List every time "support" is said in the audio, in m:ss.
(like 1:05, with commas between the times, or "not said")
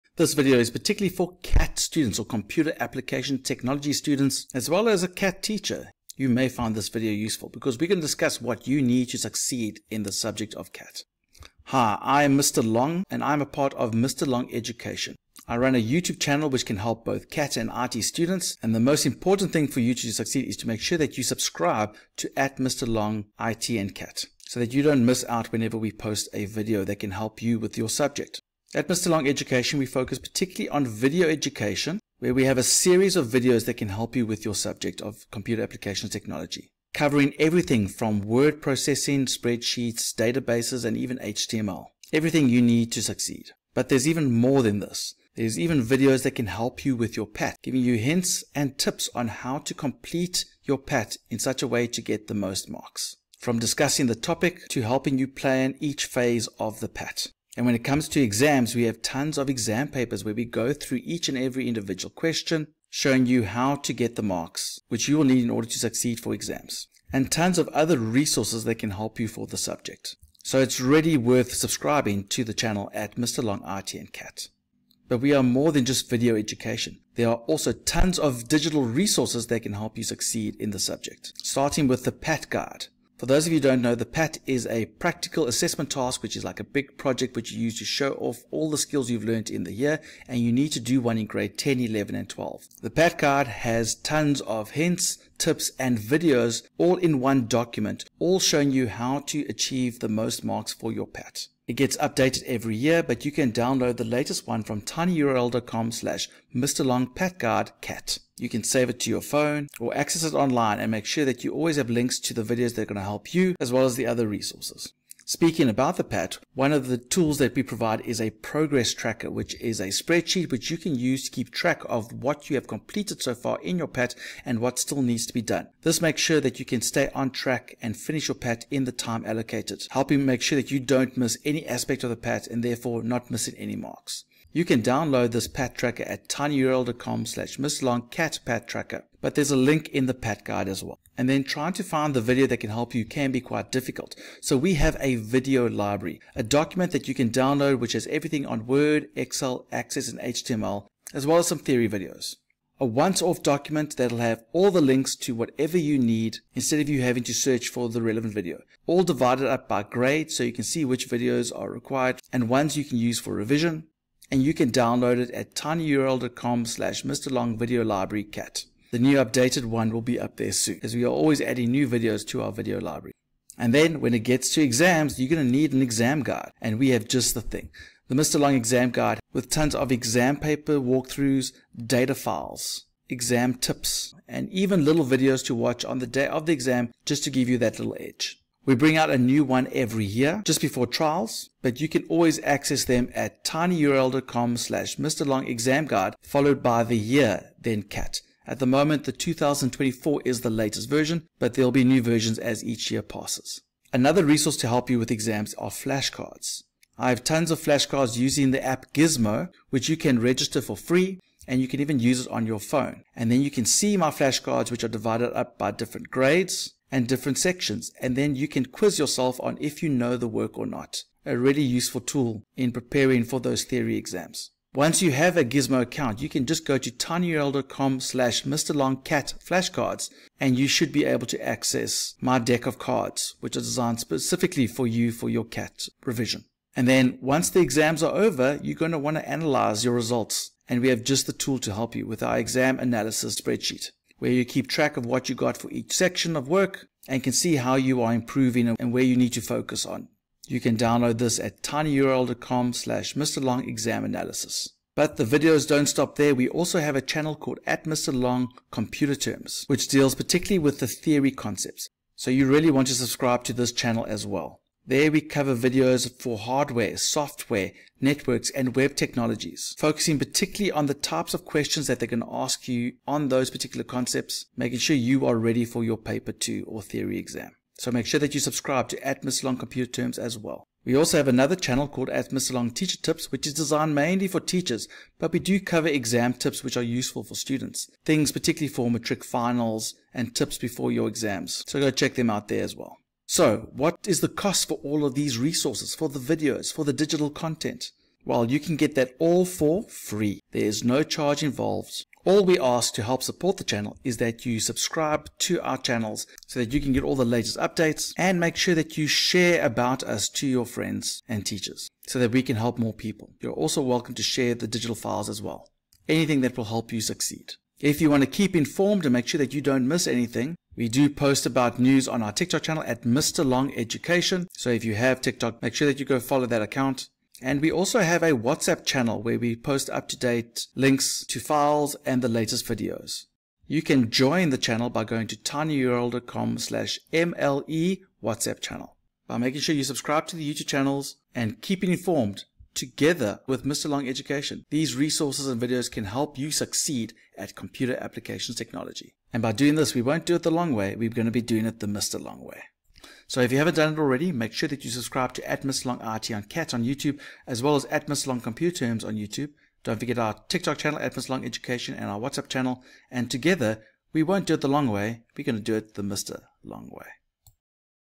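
5:03.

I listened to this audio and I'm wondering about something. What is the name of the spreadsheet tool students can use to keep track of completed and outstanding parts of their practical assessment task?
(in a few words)
progress tracker.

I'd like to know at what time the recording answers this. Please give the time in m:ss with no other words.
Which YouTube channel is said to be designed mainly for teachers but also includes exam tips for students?
4:42.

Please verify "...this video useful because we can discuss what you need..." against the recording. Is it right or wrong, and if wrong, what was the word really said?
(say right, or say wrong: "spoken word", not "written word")
right.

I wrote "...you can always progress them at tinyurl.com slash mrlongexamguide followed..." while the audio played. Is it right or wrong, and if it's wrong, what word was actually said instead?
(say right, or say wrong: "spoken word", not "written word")
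wrong: "access", not "progress".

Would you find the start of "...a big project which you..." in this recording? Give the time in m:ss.
1:26.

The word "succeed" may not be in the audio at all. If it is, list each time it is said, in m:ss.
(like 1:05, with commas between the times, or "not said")
0:09, 0:20, 0:43, 1:05, 1:20, 5:16, 5:46.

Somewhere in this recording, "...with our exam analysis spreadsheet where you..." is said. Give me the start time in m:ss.
4:02.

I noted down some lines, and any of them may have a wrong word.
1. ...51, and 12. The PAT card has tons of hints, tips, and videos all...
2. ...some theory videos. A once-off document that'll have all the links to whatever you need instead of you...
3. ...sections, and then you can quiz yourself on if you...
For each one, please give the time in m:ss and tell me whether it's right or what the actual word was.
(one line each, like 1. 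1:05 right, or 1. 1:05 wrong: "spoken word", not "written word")
1. 1:31 wrong: "11", not "51"
2. 2:31 right
3. 3:37 right.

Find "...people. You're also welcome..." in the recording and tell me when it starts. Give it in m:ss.
5:12.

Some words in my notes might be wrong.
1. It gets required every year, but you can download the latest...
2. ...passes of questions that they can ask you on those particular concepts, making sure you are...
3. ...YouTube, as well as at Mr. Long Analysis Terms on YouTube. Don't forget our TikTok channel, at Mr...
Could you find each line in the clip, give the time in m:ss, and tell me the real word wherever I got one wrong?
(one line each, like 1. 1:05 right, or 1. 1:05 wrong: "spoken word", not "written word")
1. 1:41 wrong: "updated", not "required"
2. 4:30 wrong: "types", not "passes"
3. 5:56 wrong: "Computer", not "Analysis".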